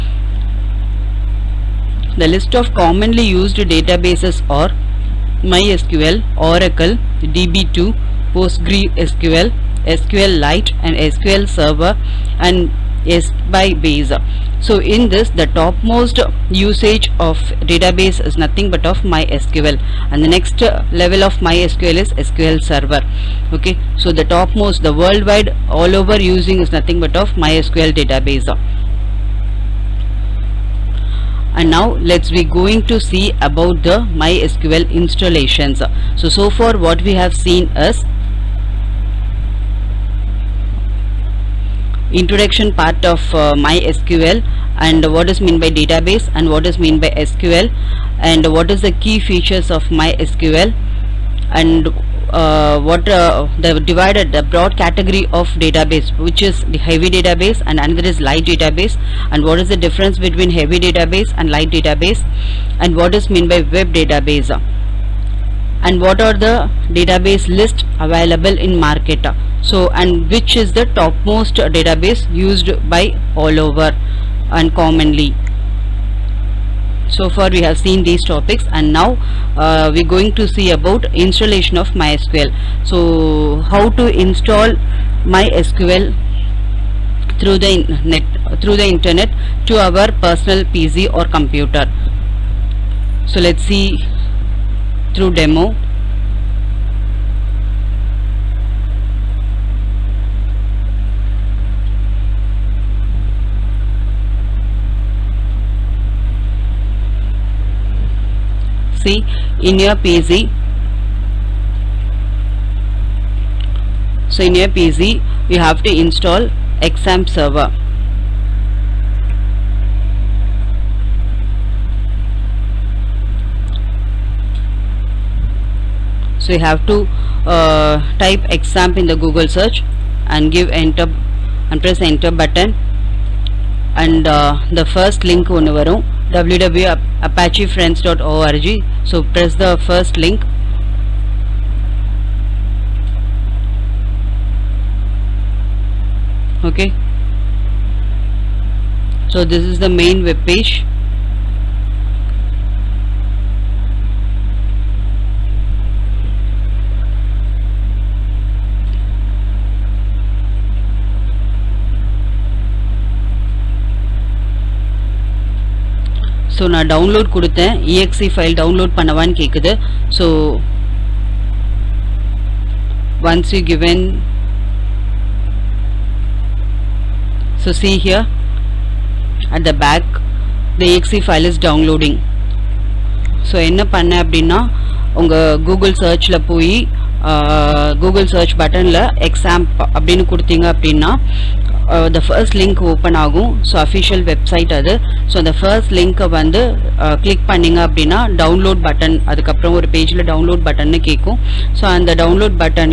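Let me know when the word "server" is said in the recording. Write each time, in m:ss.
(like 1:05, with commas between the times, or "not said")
0:11, 0:22, 1:57.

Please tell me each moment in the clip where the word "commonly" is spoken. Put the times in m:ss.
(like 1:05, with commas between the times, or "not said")
0:02, 1:14.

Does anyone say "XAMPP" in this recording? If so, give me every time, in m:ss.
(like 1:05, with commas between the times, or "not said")
1:56, 2:08.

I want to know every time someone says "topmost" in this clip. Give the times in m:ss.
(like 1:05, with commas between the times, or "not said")
0:15, 0:24, 1:11.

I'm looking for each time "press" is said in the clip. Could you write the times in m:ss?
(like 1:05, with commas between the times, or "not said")
2:11, 2:19.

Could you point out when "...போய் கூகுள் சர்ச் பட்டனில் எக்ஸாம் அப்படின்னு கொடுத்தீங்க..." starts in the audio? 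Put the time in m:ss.
3:06.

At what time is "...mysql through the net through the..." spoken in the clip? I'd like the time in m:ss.
1:25.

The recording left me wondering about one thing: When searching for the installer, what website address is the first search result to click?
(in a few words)
www.apachefriends.org.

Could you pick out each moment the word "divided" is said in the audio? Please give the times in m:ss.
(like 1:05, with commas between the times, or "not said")
0:53.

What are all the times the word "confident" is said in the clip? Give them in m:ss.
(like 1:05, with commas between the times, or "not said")
not said.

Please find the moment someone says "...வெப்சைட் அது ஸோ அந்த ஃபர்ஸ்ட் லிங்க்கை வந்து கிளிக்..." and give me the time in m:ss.
3:14.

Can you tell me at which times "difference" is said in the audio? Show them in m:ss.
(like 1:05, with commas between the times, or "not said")
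0:59.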